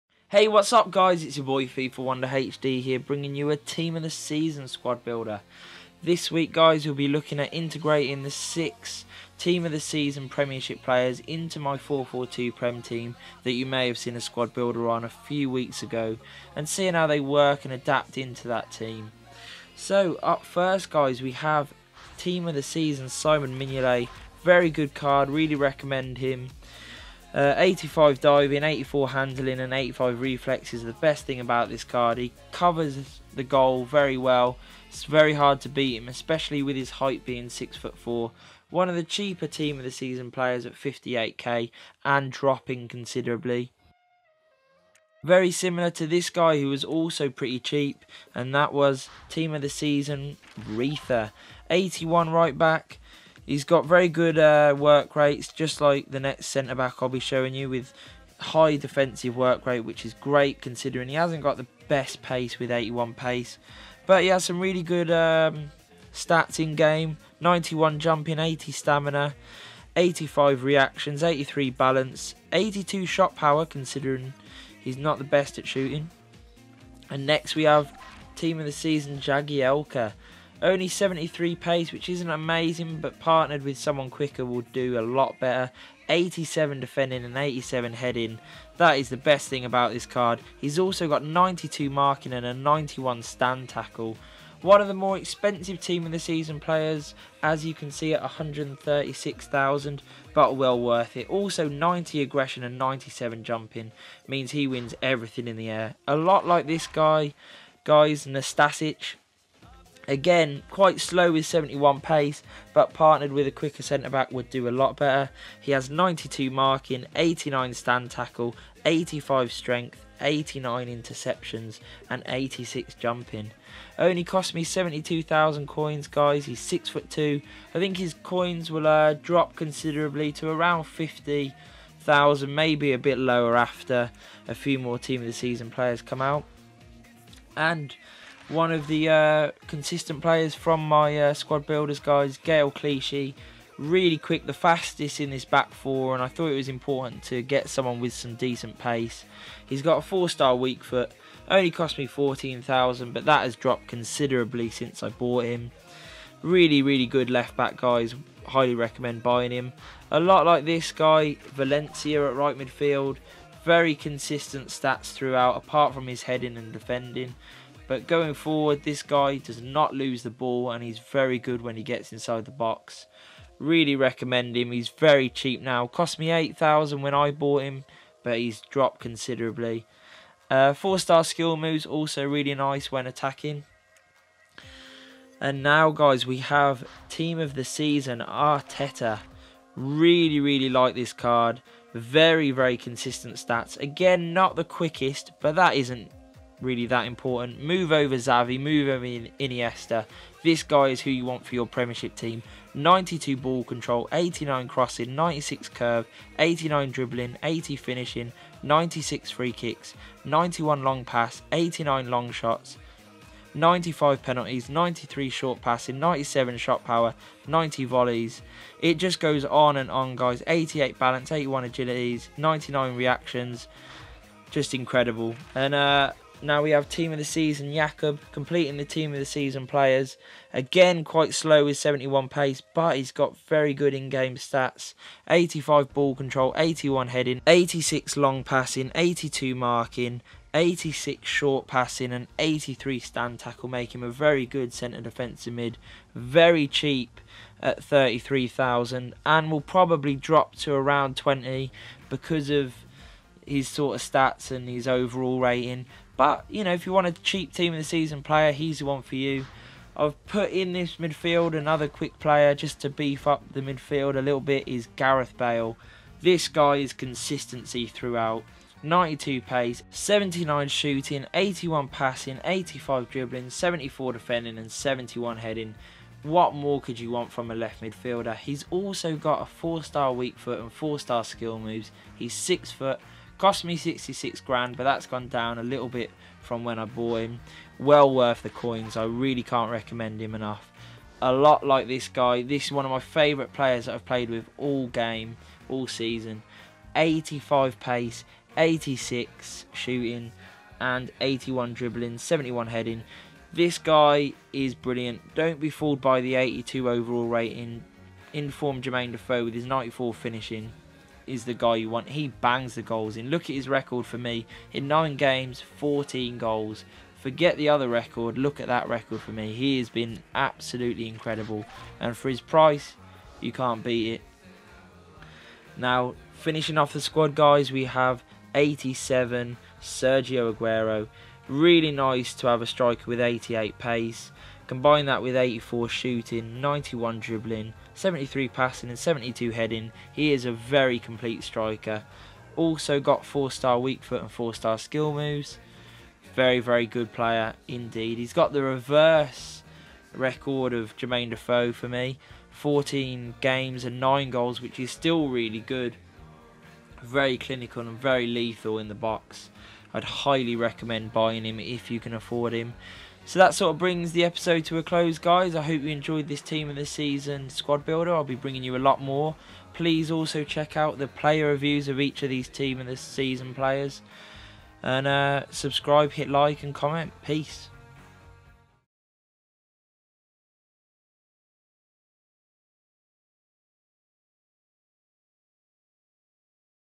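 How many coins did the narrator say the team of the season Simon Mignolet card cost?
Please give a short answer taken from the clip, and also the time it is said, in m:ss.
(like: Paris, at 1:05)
58k, at 0:40.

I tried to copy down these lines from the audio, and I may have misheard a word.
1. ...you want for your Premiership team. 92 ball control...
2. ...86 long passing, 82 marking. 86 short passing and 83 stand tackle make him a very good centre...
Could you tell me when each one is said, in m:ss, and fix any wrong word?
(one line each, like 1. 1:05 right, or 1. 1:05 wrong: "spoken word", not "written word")
1. 3:21 right
2. 3:57 right.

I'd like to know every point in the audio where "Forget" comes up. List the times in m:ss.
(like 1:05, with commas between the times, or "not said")
5:17.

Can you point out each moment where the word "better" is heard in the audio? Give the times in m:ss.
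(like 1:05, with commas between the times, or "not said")
1:25, 1:54.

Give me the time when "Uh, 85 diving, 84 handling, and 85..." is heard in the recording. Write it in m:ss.
0:27.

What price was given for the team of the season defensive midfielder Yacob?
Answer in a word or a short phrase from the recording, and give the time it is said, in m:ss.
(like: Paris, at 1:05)
33,000, at 4:07.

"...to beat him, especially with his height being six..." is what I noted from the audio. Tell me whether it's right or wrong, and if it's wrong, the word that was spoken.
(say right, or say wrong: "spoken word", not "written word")
right.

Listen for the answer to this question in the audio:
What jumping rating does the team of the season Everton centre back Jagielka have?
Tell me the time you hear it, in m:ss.
1:42.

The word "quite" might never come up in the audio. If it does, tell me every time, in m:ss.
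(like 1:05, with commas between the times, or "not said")
1:50, 3:51.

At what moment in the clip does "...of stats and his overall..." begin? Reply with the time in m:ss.
4:13.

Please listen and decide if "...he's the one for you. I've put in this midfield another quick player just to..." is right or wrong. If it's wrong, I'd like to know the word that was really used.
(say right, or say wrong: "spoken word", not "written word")
right.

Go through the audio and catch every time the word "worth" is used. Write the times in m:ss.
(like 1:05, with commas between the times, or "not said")
1:40, 4:48.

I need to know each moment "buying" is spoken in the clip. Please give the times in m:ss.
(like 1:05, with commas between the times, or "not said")
2:39, 6:01.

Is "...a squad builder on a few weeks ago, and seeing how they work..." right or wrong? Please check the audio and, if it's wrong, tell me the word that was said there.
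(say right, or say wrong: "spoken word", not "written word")
right.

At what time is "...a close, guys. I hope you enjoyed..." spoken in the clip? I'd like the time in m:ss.
6:04.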